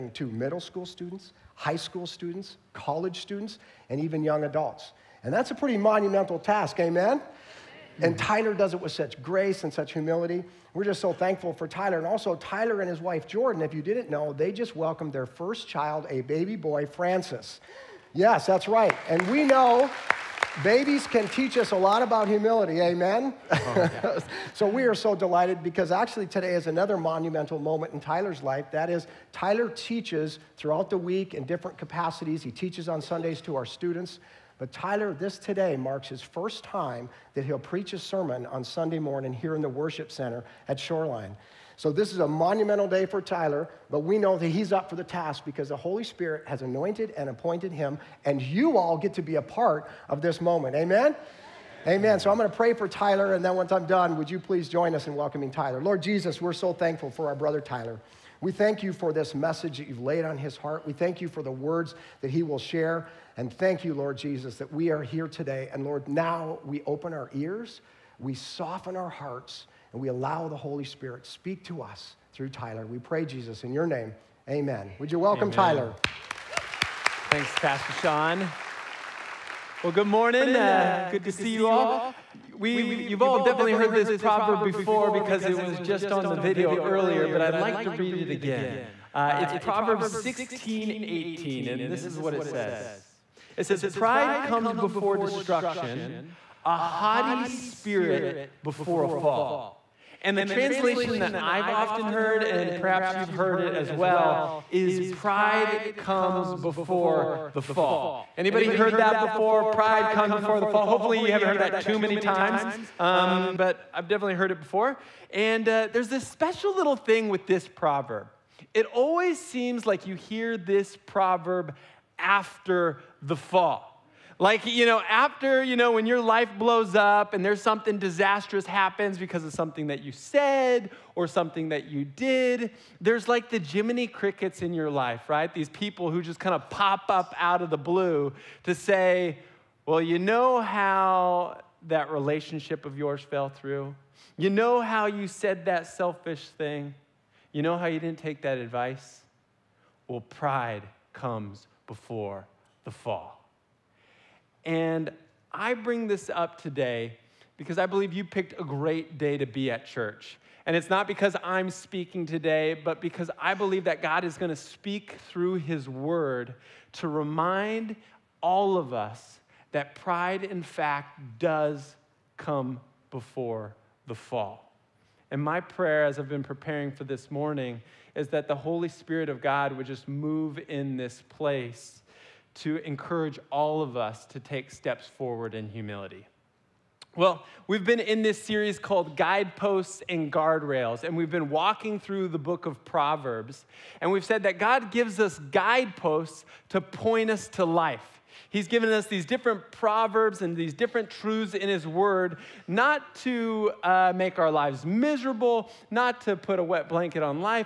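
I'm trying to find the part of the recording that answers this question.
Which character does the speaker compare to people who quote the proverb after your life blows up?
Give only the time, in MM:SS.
02:13.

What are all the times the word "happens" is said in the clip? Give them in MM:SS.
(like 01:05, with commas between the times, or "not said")
02:08.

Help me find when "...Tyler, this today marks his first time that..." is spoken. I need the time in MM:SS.
00:34.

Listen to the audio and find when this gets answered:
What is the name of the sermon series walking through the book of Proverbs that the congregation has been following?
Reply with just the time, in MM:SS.
03:09.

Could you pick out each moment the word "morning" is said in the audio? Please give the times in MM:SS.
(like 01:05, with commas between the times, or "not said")
00:38, 01:20, 02:57.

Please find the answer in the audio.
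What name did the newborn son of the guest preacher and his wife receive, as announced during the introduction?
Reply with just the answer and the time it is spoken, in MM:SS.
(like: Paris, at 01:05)
Francis, at 00:16.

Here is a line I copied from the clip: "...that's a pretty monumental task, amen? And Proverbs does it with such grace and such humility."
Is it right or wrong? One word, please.
wrong.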